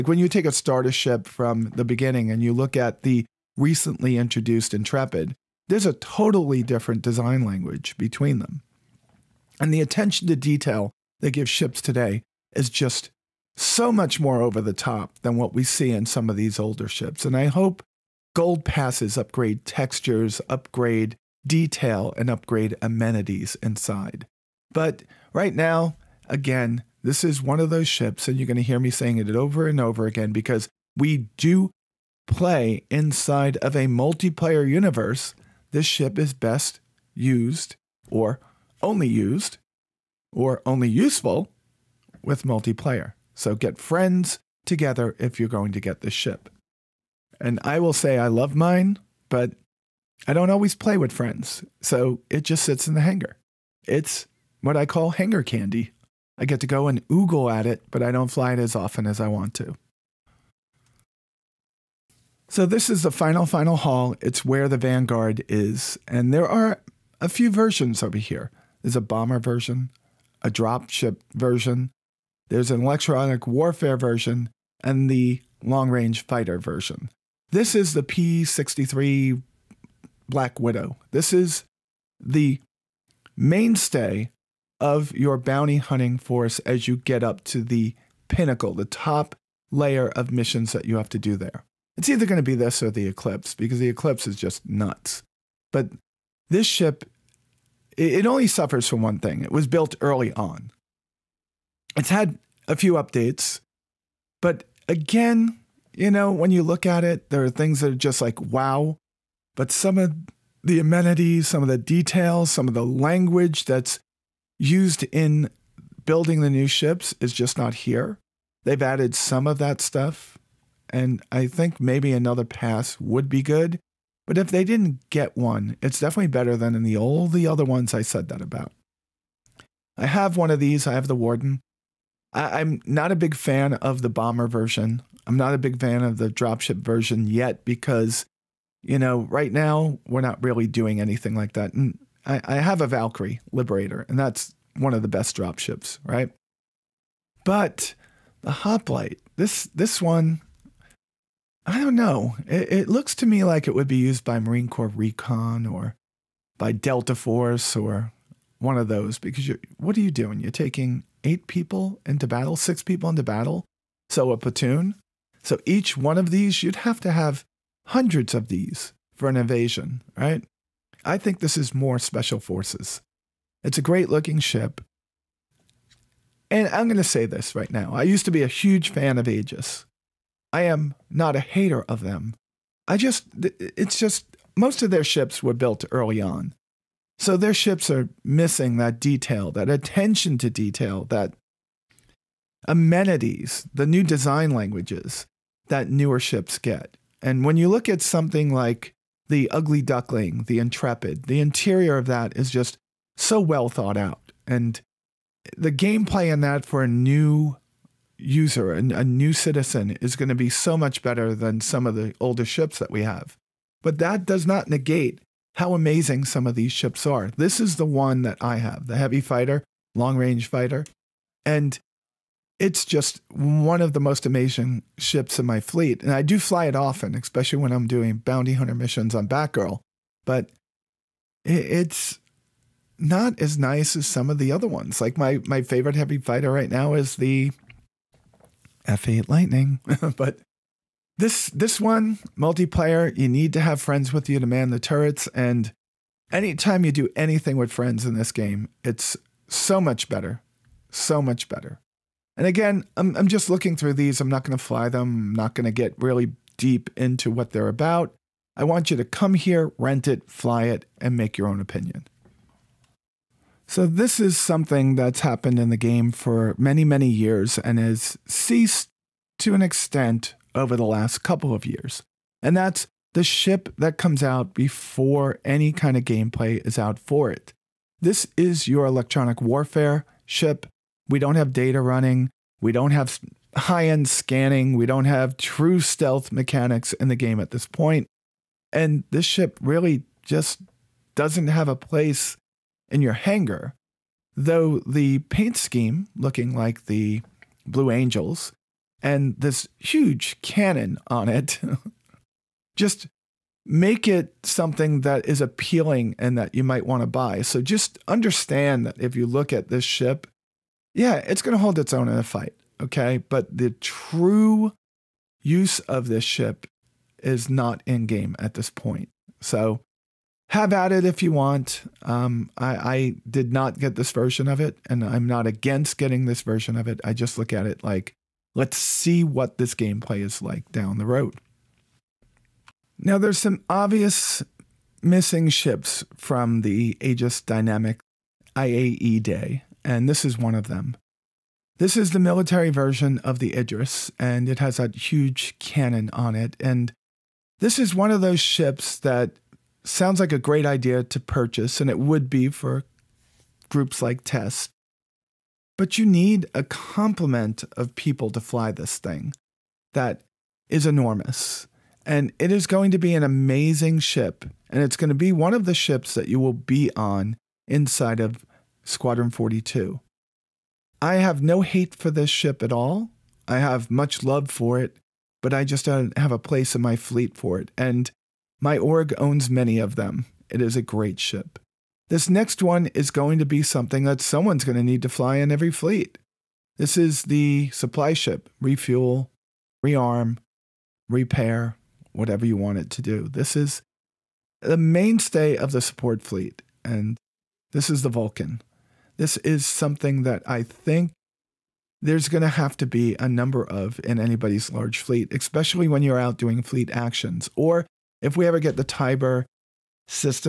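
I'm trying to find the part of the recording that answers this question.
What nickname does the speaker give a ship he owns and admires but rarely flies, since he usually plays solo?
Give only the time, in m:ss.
0:55.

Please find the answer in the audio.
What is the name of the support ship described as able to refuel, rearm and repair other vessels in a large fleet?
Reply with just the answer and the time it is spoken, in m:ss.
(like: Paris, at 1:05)
Vulcan, at 6:38.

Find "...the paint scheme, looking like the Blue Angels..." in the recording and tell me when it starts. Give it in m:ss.
4:54.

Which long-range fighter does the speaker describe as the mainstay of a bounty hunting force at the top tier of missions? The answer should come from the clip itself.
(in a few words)
P-63 Black Widow.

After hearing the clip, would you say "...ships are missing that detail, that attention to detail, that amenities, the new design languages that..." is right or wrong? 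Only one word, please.
right.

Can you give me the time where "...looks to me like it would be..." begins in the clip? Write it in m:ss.
2:32.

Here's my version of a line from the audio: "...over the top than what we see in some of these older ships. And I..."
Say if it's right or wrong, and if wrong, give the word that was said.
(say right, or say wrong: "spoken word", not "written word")
right.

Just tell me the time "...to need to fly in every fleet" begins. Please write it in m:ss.
6:24.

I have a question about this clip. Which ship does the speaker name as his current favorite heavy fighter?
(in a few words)
F8 Lightning.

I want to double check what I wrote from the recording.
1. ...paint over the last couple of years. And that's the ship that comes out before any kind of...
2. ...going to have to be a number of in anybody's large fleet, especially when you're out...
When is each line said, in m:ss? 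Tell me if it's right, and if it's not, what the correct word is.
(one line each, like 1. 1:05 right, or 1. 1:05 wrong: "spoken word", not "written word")
1. 4:29 wrong: "extent", not "paint"
2. 6:42 right.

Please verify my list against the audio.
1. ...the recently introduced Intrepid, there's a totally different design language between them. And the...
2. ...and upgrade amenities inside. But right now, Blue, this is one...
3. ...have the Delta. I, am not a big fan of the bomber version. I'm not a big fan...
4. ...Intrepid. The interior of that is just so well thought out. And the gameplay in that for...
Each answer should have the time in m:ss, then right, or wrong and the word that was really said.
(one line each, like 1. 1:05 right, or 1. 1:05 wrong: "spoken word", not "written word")
1. 0:03 right
2. 0:22 wrong: "Again", not "Blue"
3. 2:10 wrong: "Warden", not "Delta"
4. 3:20 right.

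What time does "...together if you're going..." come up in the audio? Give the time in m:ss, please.
0:44.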